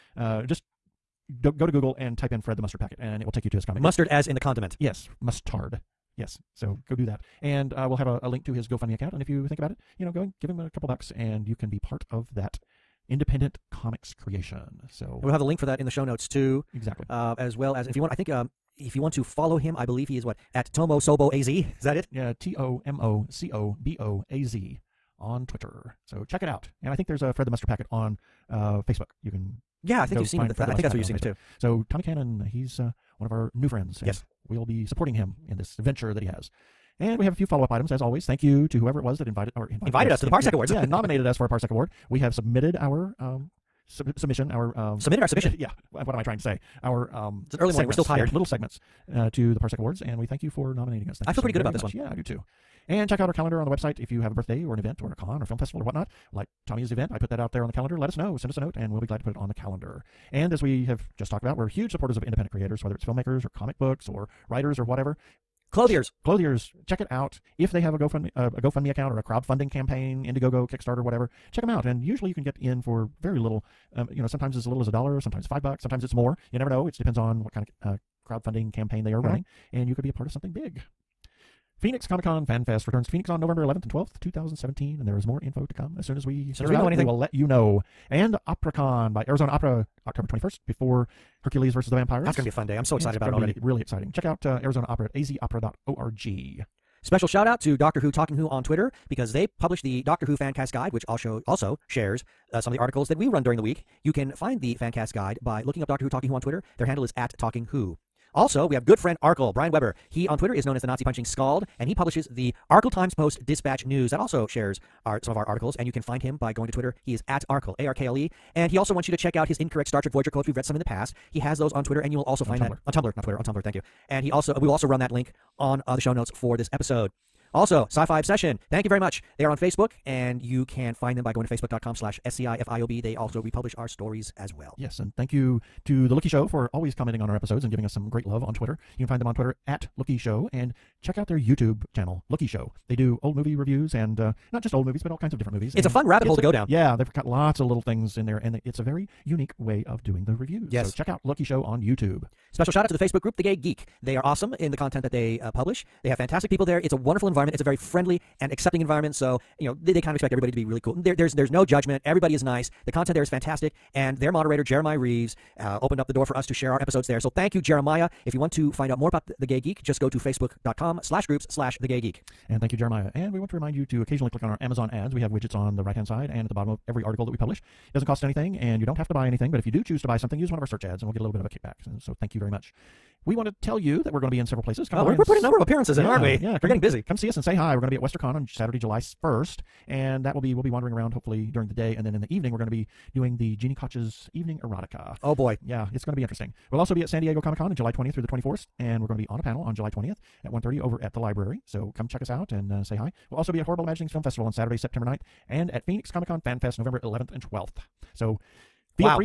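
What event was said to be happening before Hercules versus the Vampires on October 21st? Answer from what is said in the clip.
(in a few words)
OperaCon.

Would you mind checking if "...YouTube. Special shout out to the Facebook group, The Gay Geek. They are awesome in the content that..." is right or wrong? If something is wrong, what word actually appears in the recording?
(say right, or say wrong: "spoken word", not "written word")
right.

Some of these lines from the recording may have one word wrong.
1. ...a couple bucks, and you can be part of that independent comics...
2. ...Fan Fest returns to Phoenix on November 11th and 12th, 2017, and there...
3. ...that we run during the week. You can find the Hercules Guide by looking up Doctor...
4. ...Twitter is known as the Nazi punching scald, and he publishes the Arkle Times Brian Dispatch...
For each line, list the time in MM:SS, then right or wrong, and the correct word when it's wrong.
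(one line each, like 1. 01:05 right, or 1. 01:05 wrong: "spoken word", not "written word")
1. 00:10 right
2. 01:22 right
3. 01:43 wrong: "Fancast", not "Hercules"
4. 01:50 wrong: "Post", not "Brian".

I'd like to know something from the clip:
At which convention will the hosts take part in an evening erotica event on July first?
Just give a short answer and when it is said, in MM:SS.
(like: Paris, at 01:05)
WesterCon, at 03:07.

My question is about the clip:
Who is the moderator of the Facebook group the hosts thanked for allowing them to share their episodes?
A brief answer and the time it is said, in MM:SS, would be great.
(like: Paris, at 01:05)
Jeremiah Reeves, at 02:44.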